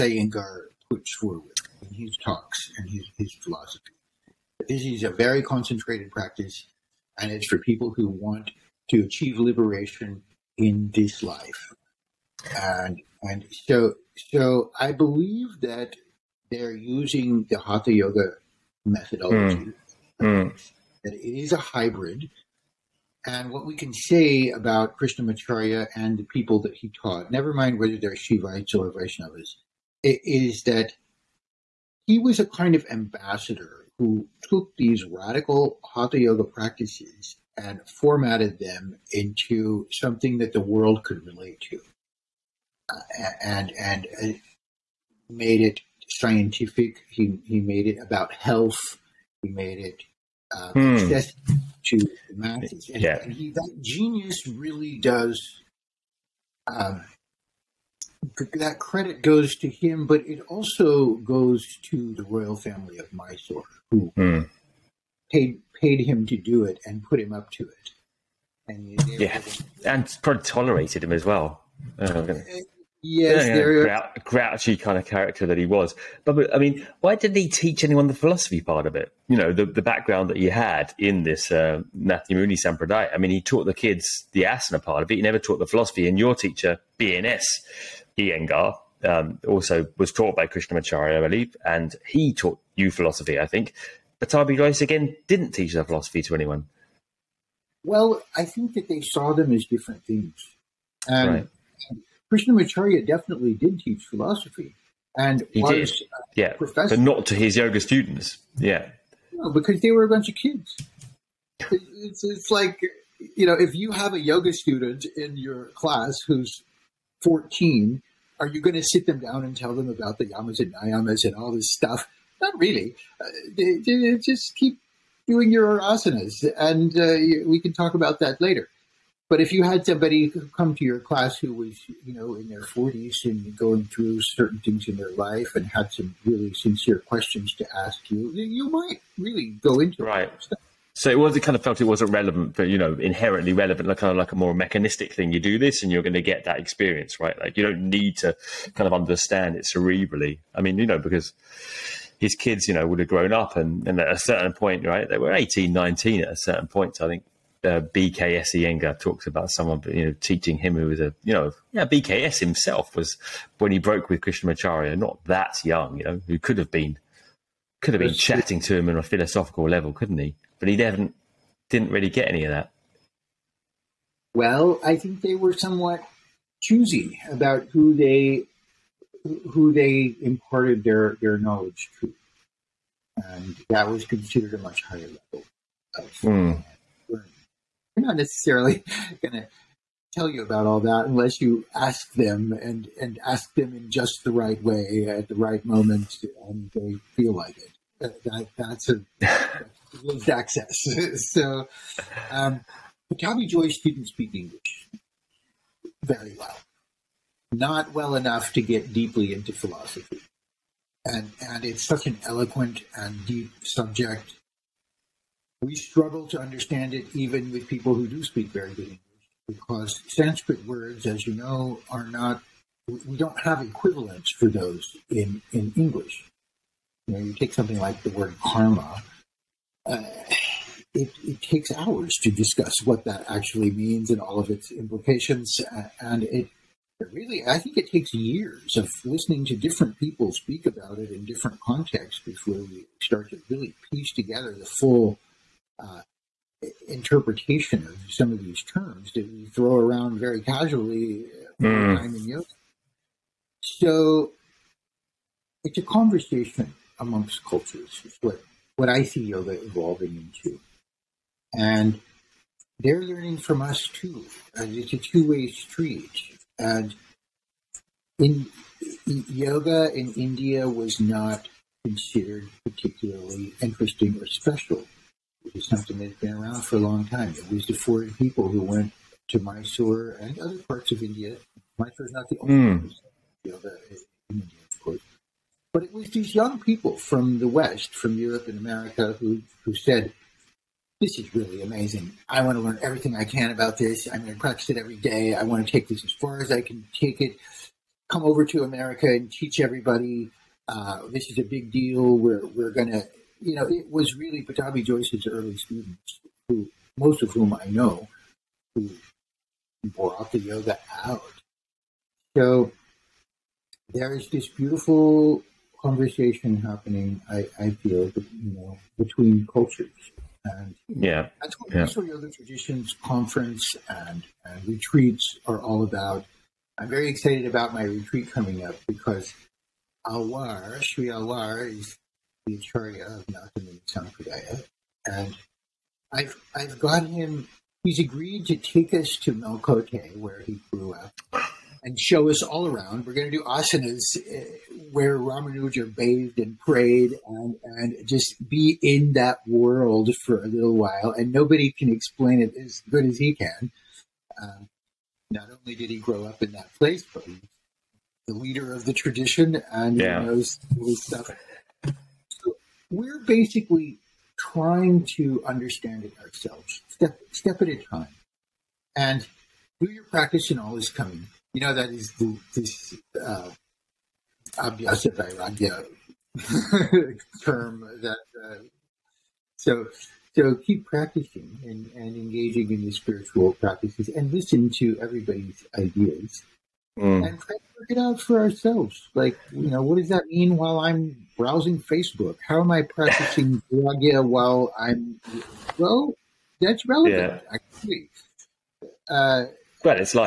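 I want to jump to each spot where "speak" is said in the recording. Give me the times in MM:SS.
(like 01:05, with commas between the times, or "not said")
03:24, 03:38, 04:00.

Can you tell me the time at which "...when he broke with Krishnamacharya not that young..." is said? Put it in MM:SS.
02:43.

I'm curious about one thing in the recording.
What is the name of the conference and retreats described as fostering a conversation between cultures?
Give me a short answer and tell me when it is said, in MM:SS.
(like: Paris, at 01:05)
Eastern Yoga Traditions, at 05:21.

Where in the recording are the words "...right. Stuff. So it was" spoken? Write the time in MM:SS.
02:20.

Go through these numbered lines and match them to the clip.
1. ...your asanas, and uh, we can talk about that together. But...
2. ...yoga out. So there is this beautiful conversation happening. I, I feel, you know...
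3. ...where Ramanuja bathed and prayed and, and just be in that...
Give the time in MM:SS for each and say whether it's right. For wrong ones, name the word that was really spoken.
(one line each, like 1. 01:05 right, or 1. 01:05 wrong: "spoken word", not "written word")
1. 02:05 wrong: "later", not "together"
2. 05:10 right
3. 05:44 right.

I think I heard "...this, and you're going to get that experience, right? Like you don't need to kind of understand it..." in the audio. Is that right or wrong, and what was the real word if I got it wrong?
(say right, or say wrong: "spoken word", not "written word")
right.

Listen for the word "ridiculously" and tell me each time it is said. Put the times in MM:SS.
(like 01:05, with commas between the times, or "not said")
not said.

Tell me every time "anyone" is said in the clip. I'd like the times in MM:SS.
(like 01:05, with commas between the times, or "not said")
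01:17, 01:36.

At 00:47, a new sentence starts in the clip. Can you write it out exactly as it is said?
He he made it about health.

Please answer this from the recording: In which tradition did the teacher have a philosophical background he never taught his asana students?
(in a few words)
Nathamuni Sampradaya.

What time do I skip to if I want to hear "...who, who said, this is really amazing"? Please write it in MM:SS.
04:49.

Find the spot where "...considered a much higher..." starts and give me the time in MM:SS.
03:04.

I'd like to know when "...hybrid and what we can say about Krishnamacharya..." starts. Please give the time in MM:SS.
00:21.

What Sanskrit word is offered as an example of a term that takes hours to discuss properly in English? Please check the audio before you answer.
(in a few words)
Karma.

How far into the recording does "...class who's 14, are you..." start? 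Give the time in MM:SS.
01:55.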